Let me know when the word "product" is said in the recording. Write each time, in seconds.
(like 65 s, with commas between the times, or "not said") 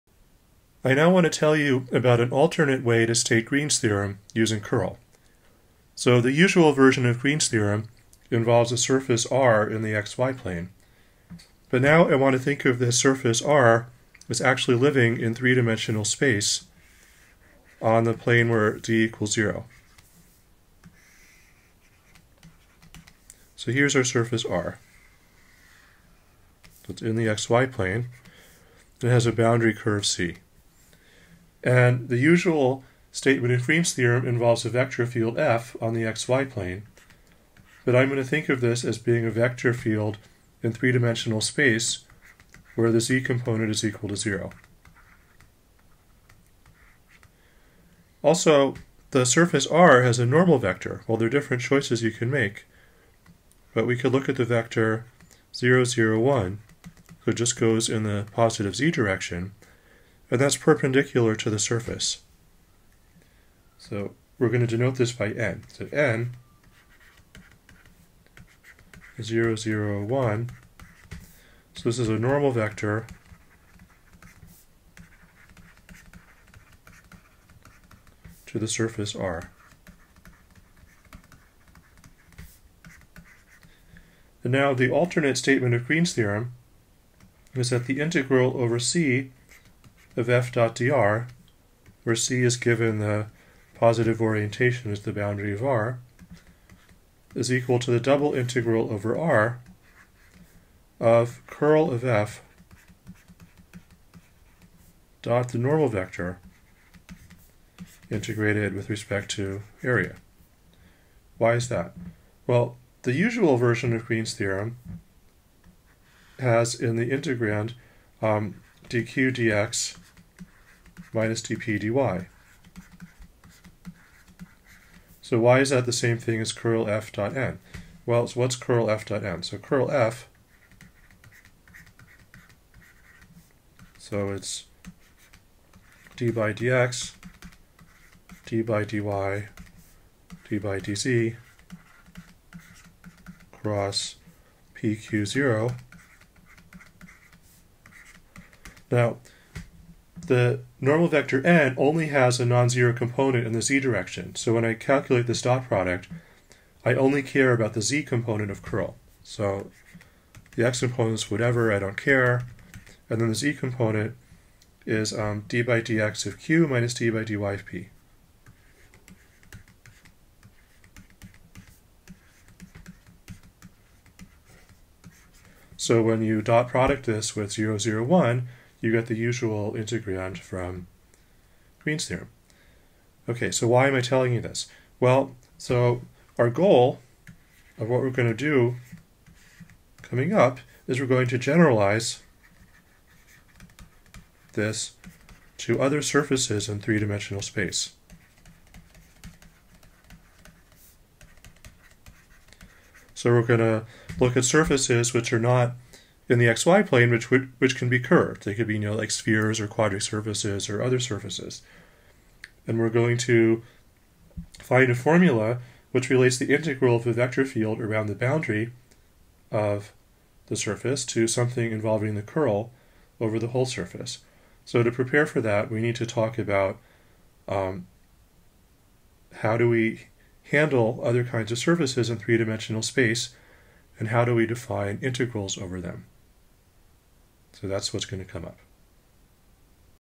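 155 s, 176 s.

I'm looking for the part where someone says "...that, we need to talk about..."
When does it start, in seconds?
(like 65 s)
225 s.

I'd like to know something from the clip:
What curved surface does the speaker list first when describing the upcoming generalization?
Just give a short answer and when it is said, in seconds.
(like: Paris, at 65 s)
spheres, at 209 s.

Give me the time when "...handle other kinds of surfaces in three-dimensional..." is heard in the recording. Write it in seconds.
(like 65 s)
230 s.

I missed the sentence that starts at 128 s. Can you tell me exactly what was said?
Well, so what's curl f dot n?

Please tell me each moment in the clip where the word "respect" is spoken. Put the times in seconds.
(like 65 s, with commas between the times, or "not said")
108 s.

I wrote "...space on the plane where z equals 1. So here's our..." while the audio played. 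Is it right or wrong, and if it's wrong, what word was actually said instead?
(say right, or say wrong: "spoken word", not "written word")
wrong: "0", not "1".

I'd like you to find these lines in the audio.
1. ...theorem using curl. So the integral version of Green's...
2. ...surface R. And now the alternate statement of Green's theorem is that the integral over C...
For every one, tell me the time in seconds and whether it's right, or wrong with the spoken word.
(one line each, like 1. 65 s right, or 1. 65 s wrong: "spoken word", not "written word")
1. 3 s wrong: "usual", not "integral"
2. 78 s right.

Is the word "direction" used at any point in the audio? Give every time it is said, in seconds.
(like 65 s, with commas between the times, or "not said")
58 s, 153 s.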